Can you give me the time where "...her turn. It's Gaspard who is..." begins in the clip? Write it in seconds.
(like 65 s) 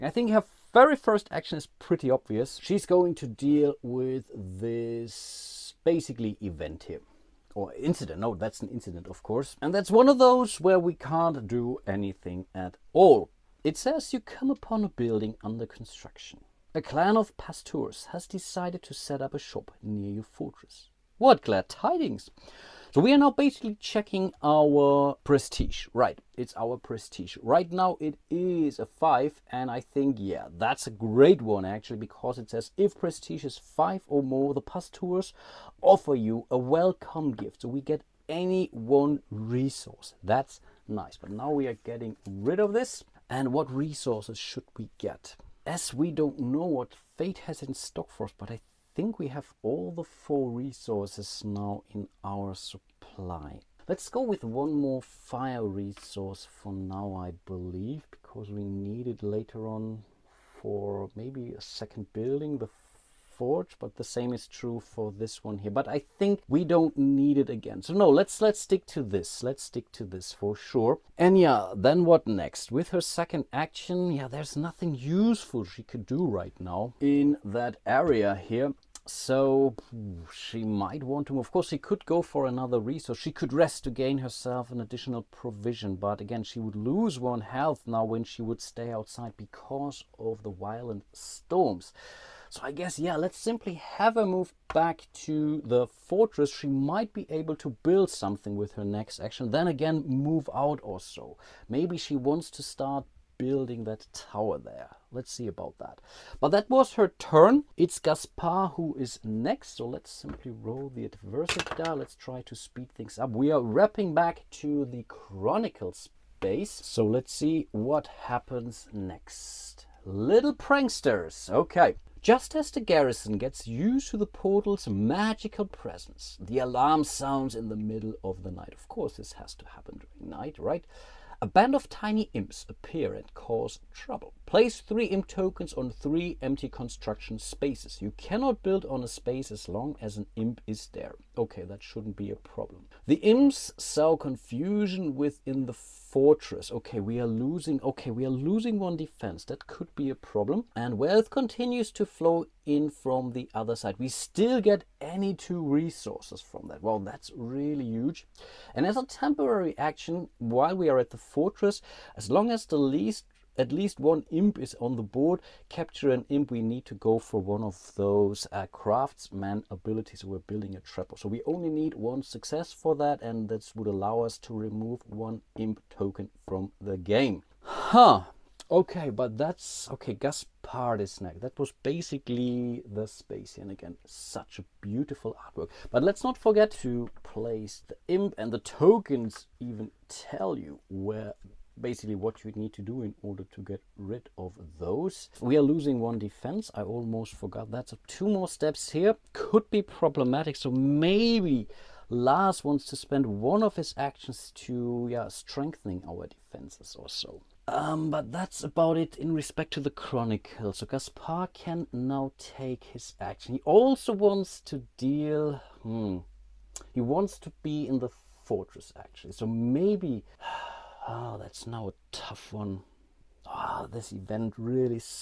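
106 s.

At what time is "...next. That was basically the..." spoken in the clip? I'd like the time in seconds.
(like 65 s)
181 s.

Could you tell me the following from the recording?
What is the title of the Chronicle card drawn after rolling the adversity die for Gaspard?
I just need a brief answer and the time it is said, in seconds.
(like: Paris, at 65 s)
Little pranksters, at 120 s.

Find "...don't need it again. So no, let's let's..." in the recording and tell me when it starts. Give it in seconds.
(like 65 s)
66 s.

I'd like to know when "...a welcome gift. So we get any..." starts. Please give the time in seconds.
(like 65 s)
36 s.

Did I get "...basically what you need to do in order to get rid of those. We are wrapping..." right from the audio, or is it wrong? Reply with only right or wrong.
wrong.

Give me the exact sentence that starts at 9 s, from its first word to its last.
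And that's one of those where we can't do anything at all.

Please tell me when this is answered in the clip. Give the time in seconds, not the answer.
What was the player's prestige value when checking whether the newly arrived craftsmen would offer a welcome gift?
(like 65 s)
27 s.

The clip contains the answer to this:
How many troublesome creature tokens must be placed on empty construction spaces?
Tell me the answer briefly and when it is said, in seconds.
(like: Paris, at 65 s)
3, at 134 s.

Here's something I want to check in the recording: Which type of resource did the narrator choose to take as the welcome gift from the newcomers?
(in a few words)
fire.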